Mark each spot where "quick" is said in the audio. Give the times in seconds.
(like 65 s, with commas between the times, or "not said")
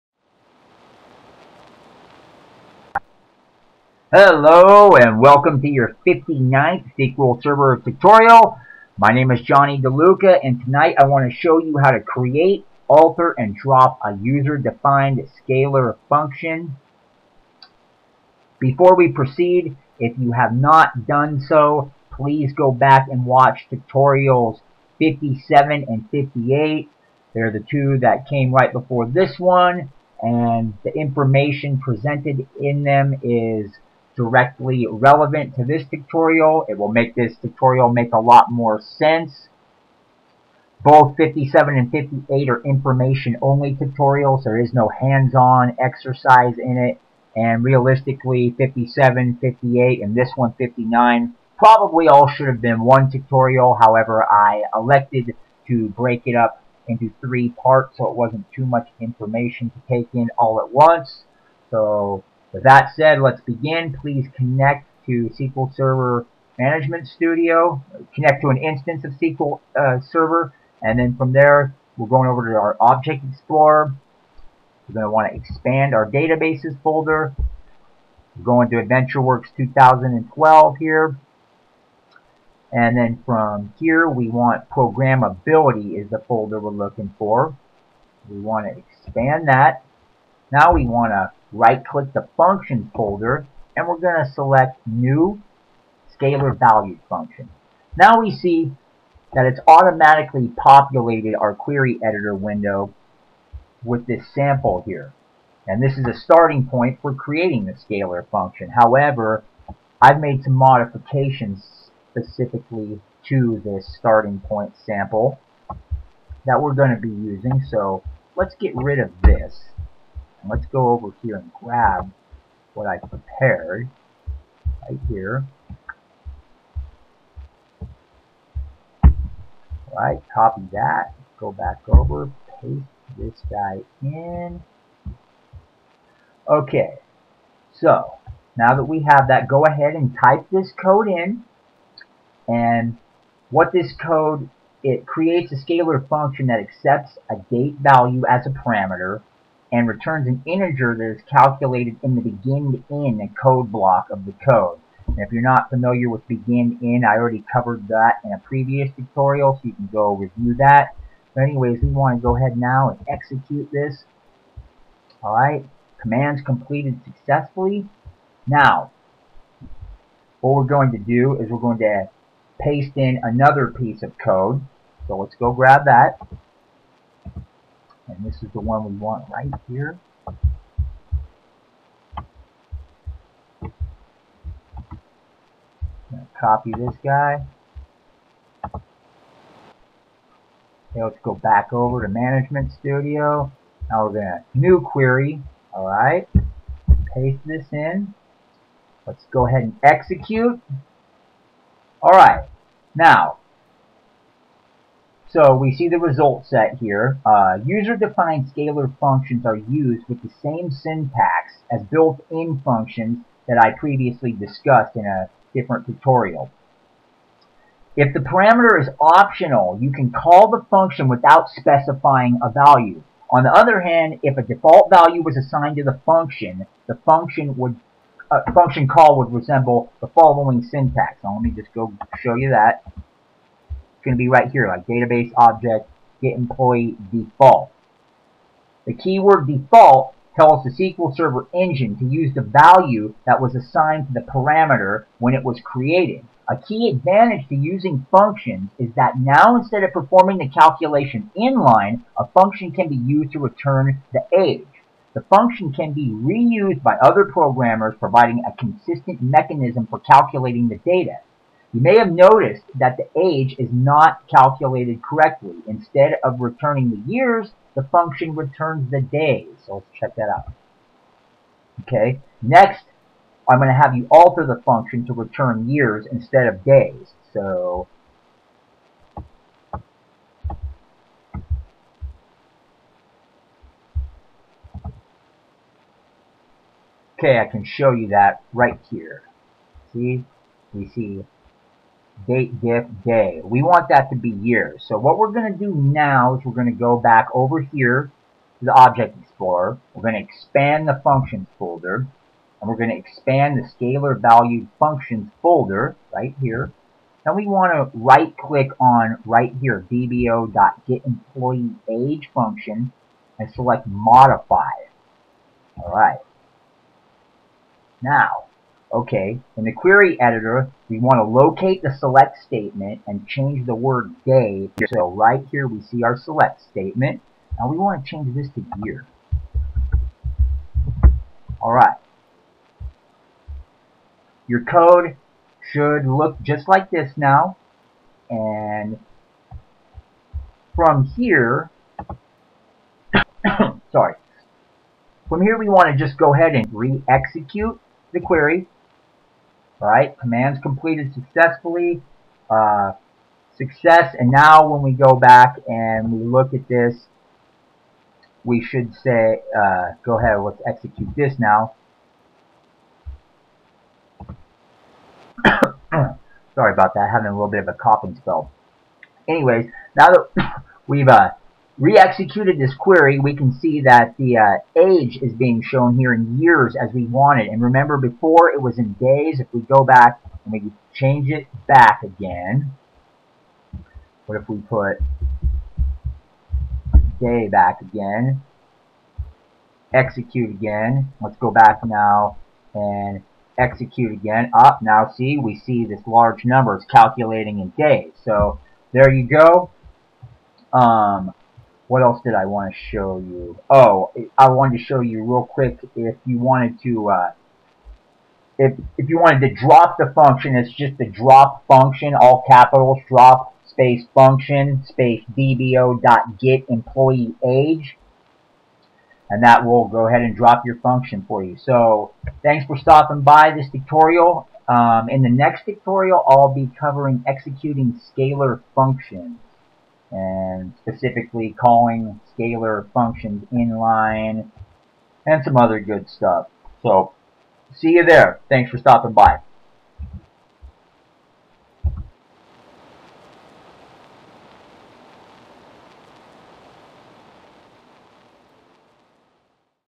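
405 s.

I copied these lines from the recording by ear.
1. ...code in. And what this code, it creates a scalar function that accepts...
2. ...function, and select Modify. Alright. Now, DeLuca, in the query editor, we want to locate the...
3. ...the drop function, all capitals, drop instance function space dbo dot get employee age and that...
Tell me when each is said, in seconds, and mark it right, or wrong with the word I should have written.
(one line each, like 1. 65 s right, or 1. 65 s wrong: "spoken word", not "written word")
1. 140 s right
2. 312 s wrong: "Okay", not "DeLuca"
3. 410 s wrong: "space", not "instance".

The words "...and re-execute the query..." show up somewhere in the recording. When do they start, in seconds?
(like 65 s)
346 s.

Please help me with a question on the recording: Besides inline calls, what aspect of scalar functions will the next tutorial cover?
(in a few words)
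executing scalar functions.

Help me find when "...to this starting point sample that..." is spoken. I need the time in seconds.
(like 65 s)
113 s.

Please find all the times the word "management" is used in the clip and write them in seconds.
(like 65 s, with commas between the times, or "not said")
66 s, 192 s.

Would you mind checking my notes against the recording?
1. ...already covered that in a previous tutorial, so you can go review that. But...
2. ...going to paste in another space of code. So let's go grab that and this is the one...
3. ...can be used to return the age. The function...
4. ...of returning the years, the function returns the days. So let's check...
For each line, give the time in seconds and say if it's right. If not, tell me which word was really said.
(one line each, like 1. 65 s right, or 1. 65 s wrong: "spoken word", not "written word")
1. 157 s right
2. 171 s wrong: "piece", not "space"
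3. 252 s right
4. 266 s right.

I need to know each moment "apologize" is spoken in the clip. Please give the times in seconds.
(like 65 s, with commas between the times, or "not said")
not said.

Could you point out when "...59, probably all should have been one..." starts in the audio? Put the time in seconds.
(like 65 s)
50 s.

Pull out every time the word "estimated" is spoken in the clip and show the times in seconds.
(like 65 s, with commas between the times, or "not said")
not said.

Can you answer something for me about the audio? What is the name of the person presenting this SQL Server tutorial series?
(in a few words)
Johnny DeLuca.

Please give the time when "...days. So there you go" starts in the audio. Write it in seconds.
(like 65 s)
397 s.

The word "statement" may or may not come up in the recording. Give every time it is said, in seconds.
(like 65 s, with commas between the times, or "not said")
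322 s, 326 s.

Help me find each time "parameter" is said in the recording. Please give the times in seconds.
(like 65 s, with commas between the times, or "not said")
148 s, 218 s, 244 s.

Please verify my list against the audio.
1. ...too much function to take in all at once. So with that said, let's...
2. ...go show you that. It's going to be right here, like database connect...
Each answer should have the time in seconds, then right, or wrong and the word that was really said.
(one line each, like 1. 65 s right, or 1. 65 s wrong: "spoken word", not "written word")
1. 58 s wrong: "information", not "function"
2. 231 s wrong: "object", not "connect".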